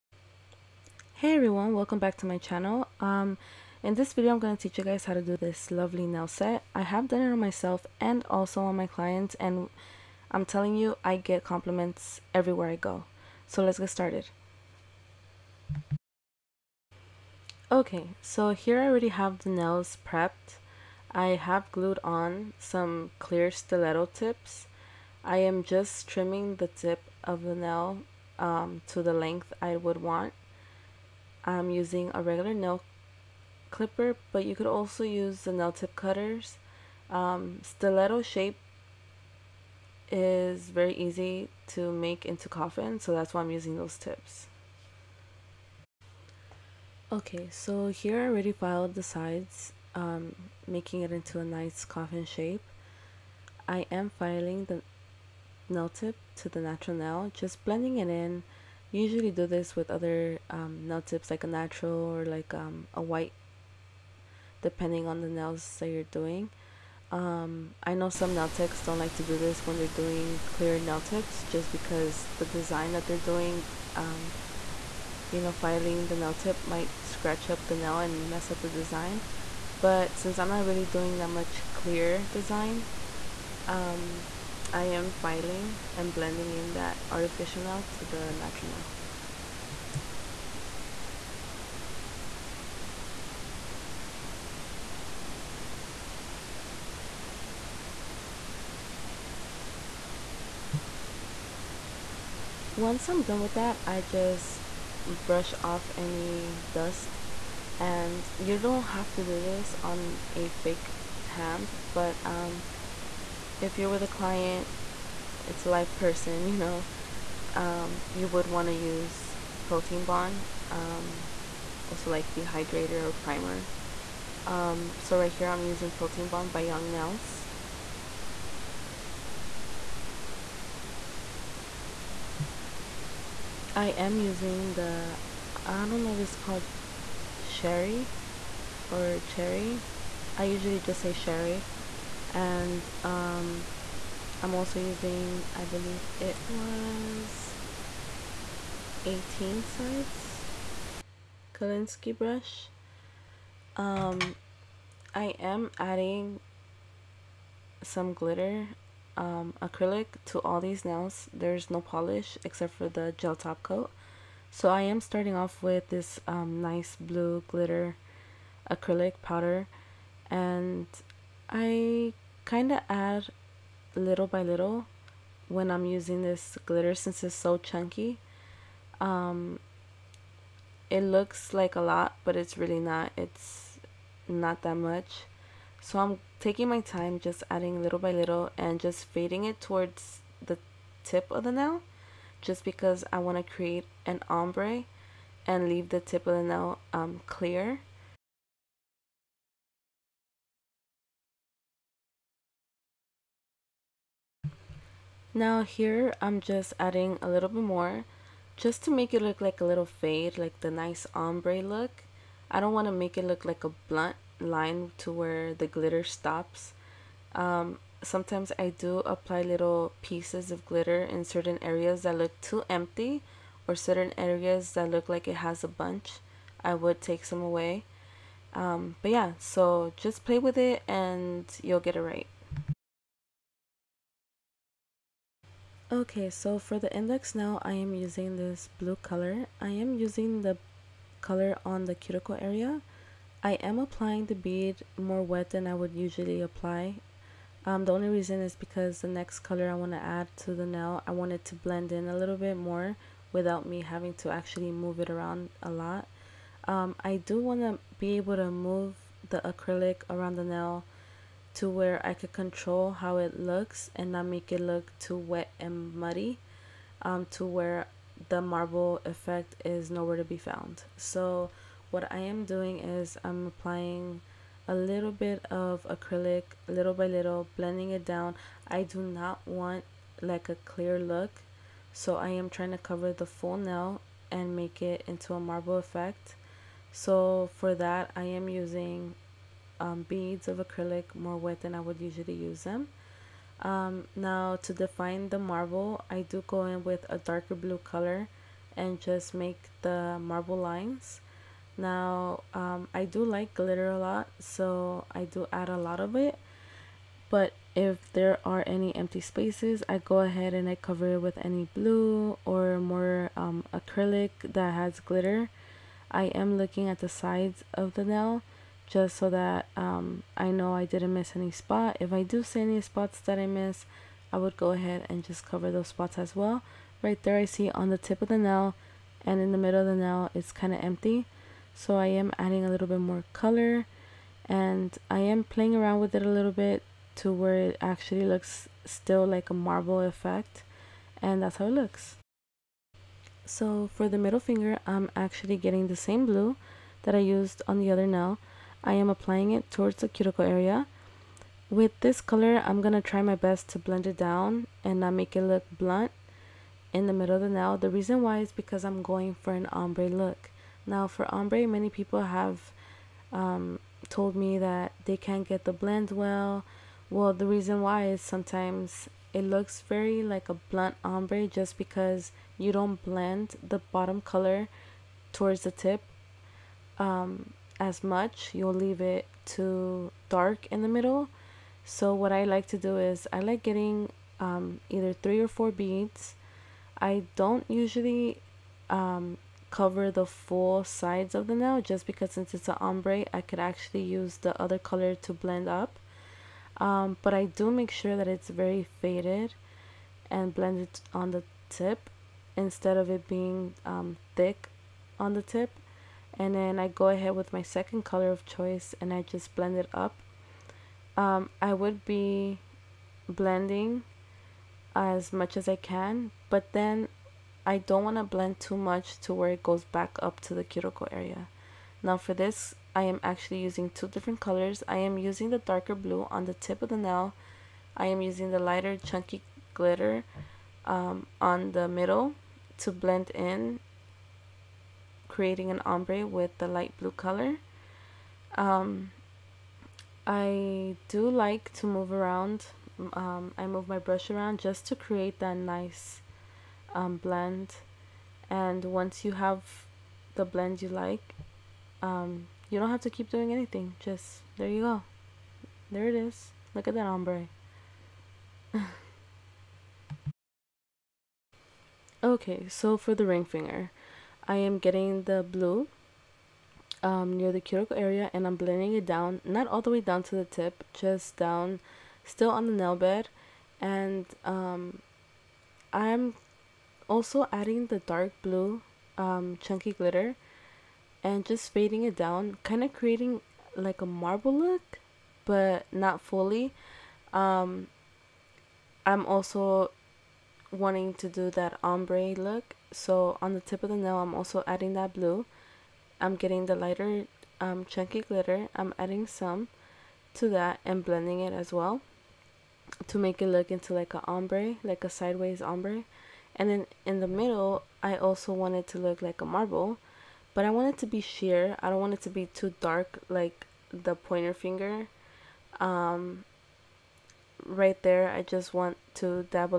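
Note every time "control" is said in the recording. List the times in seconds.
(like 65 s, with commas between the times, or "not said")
262 s.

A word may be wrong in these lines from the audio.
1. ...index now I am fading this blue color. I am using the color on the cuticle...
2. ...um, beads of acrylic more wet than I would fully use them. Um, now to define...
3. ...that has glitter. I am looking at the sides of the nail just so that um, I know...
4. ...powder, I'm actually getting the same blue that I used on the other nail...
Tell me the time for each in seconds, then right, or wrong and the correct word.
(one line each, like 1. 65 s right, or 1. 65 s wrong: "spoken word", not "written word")
1. 236 s wrong: "using", not "fading"
2. 289 s wrong: "usually", not "fully"
3. 314 s right
4. 344 s wrong: "finger", not "powder".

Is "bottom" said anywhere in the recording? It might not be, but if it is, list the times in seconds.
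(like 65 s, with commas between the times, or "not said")
373 s.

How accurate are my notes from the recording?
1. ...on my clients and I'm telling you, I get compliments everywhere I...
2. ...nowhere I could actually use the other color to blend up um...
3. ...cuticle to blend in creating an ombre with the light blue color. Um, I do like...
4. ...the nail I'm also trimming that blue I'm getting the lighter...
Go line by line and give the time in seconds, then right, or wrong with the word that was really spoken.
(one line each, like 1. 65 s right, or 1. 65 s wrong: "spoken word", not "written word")
1. 8 s right
2. 392 s wrong: "ombre", not "nowhere"
3. 431 s wrong: "middle", not "cuticle"
4. 493 s wrong: "adding", not "trimming".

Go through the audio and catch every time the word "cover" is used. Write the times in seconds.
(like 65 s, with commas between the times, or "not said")
282 s, 310 s, 325 s, 389 s.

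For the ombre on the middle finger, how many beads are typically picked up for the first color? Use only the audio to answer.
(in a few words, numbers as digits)
Three or four.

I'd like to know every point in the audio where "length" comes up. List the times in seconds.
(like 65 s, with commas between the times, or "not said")
29 s.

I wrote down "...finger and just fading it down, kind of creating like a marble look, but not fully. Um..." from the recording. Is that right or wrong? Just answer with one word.
wrong.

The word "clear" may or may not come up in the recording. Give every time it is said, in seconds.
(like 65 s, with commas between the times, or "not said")
23 s, 70 s, 81 s, 197 s, 280 s.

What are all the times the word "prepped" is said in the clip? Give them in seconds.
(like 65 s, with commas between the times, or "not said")
20 s.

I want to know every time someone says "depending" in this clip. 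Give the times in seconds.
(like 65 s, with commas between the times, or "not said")
64 s.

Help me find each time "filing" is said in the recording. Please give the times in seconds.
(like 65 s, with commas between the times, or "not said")
54 s, 75 s, 85 s.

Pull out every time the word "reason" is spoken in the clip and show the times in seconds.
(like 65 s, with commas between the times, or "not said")
248 s, 357 s, 367 s.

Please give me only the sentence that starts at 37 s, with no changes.
Um, stiletto shape is very easy to make into coffin, so that's why I'm using those tips.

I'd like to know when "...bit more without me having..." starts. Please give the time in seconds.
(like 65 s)
252 s.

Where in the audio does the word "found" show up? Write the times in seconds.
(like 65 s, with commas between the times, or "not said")
270 s.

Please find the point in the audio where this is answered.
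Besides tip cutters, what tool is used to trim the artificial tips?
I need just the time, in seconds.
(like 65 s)
32 s.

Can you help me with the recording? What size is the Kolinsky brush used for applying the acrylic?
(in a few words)
18.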